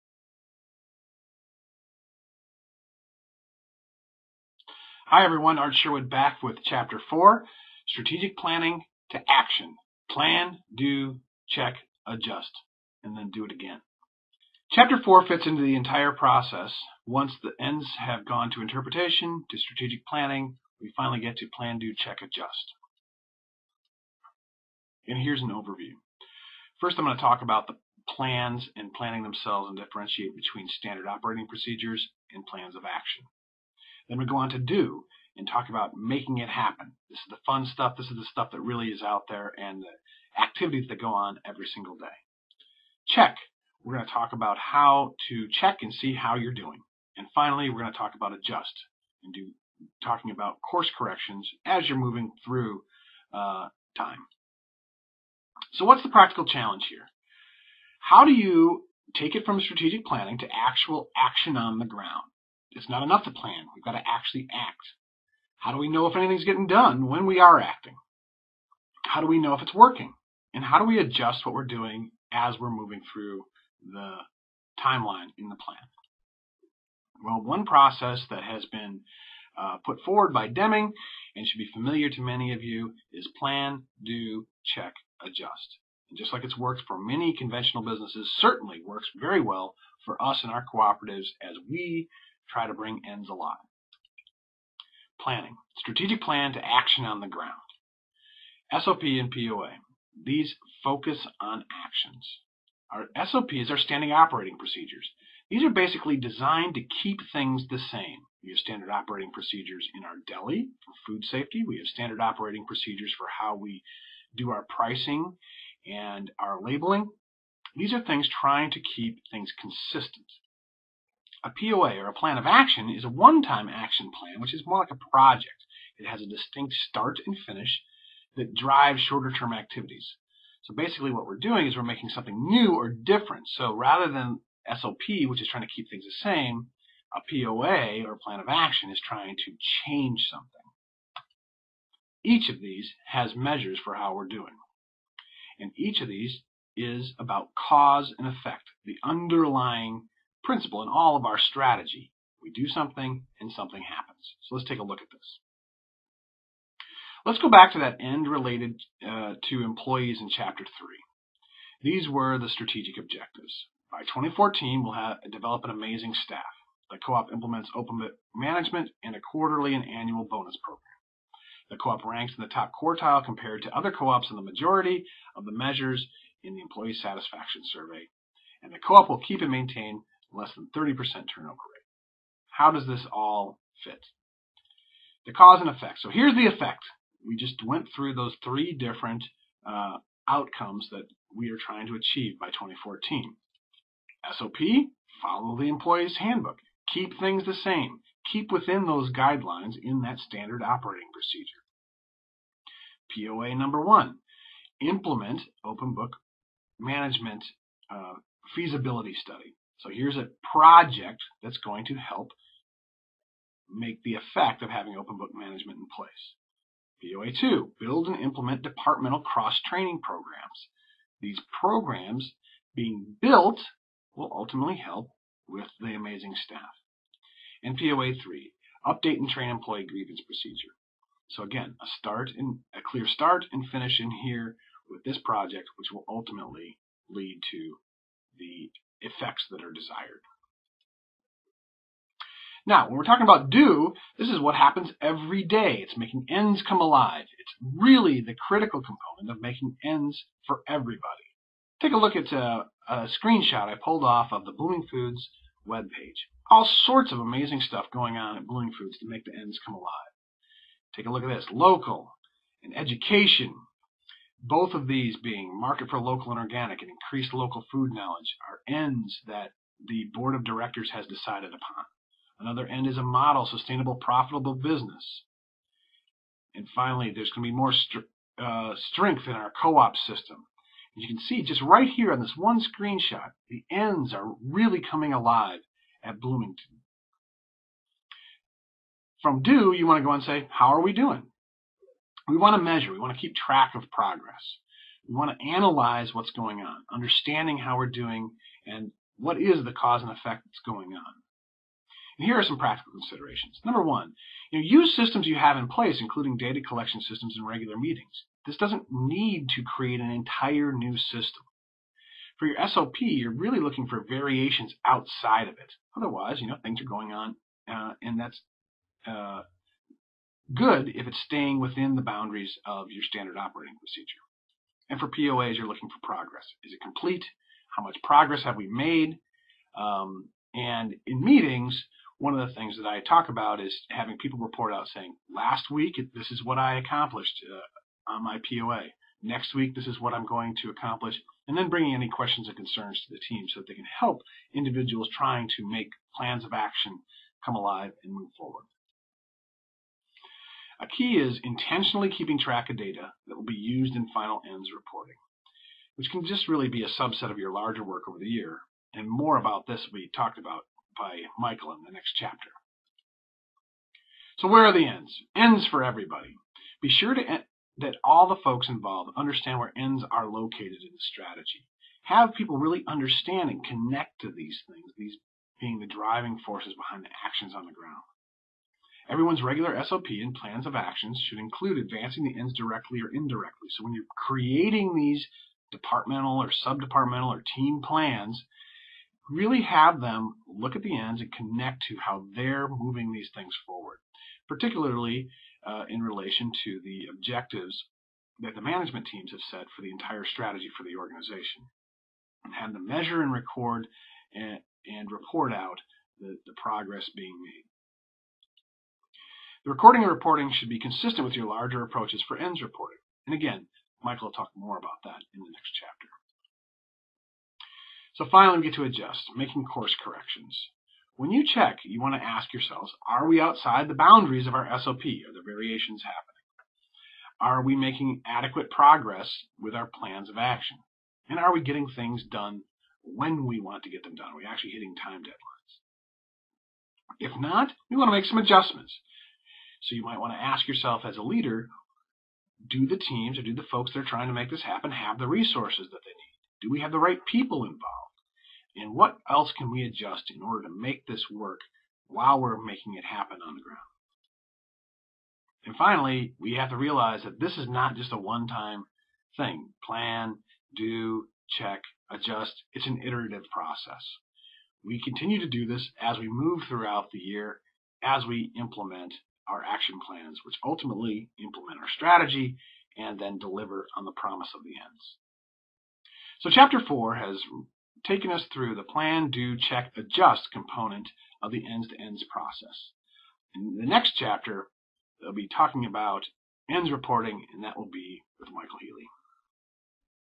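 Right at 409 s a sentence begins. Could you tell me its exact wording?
The recording and reporting should be consistent with your larger approaches for ends reporting.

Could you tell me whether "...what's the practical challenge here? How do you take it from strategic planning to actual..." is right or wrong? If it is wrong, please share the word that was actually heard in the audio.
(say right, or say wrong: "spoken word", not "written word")
right.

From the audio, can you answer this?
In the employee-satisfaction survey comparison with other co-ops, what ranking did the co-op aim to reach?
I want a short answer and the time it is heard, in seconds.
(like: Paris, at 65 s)
top quartile, at 172 s.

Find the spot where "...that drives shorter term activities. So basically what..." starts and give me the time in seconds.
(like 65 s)
128 s.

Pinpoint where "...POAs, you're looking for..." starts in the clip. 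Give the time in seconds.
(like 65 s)
325 s.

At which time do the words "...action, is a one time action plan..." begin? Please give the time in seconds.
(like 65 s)
122 s.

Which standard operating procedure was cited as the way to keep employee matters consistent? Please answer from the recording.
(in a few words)
follow the employee's handbook.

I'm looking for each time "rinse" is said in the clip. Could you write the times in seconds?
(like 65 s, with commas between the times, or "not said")
not said.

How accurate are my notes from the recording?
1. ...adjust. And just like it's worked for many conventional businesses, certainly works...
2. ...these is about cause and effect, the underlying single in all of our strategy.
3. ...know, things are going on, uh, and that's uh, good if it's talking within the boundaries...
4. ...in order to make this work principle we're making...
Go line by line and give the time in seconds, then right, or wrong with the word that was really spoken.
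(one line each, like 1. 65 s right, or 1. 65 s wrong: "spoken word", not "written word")
1. 85 s right
2. 146 s wrong: "principle", not "single"
3. 316 s wrong: "staying", not "talking"
4. 450 s wrong: "while", not "principle".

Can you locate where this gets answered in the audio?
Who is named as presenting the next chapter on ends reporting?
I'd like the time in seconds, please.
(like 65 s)
488 s.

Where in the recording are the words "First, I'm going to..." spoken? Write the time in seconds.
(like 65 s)
26 s.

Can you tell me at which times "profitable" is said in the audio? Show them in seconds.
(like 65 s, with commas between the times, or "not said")
273 s.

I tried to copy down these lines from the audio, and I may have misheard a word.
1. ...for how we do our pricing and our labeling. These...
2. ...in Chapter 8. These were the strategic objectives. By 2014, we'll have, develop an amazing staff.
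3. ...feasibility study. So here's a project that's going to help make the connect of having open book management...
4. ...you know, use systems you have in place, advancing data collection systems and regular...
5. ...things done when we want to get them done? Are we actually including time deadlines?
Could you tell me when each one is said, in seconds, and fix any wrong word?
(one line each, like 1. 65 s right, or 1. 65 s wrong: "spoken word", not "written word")
1. 113 s right
2. 160 s wrong: "3", not "8"
3. 208 s wrong: "effect", not "connect"
4. 304 s wrong: "including", not "advancing"
5. 431 s wrong: "hitting", not "including".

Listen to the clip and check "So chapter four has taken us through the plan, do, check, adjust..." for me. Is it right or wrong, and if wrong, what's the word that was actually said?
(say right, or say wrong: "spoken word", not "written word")
right.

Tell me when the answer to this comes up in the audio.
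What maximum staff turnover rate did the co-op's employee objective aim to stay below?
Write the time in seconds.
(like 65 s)
180 s.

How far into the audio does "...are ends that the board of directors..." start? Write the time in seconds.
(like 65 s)
268 s.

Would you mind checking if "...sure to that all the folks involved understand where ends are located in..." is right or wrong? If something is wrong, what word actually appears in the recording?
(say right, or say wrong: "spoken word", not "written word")
right.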